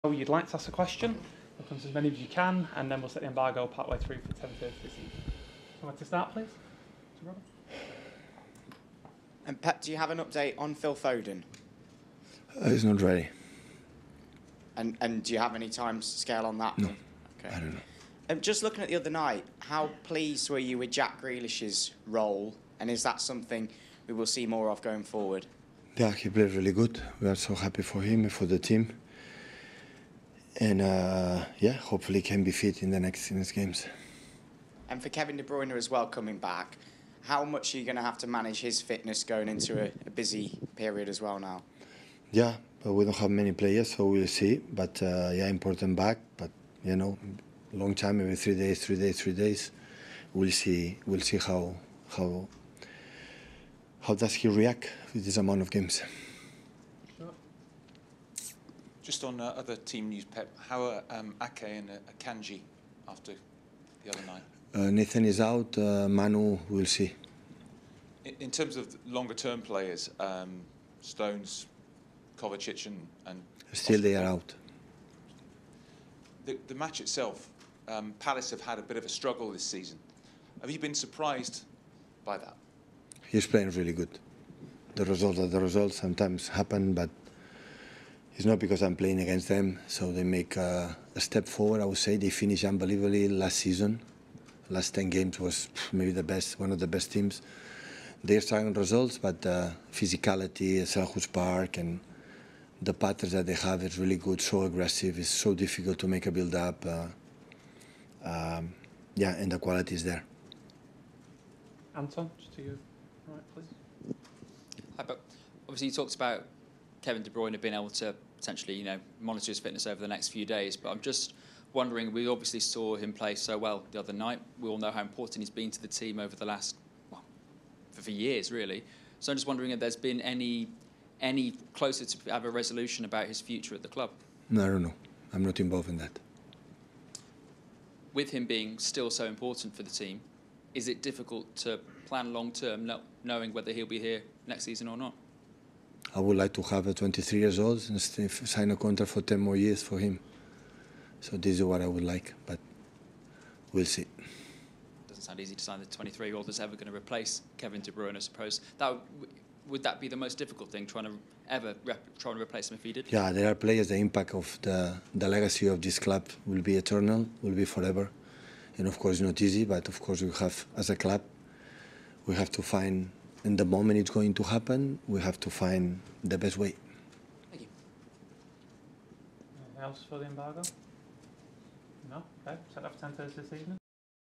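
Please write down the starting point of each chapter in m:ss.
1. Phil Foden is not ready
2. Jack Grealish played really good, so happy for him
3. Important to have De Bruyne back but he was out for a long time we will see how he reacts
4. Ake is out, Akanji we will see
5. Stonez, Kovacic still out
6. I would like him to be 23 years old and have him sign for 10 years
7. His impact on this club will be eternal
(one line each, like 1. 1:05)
1. 0:13
2. 0:26
3. 0:43
4. 1:04
5. 1:14
6. 2:28
7. 2:45.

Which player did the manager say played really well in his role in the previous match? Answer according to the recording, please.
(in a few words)
Jack Grealish.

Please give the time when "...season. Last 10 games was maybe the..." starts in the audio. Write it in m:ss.
1:33.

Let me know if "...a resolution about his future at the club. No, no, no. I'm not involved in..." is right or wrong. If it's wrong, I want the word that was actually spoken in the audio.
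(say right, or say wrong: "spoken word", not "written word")
right.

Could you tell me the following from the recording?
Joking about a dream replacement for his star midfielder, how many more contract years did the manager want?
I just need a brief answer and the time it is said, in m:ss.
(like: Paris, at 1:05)
10, at 2:29.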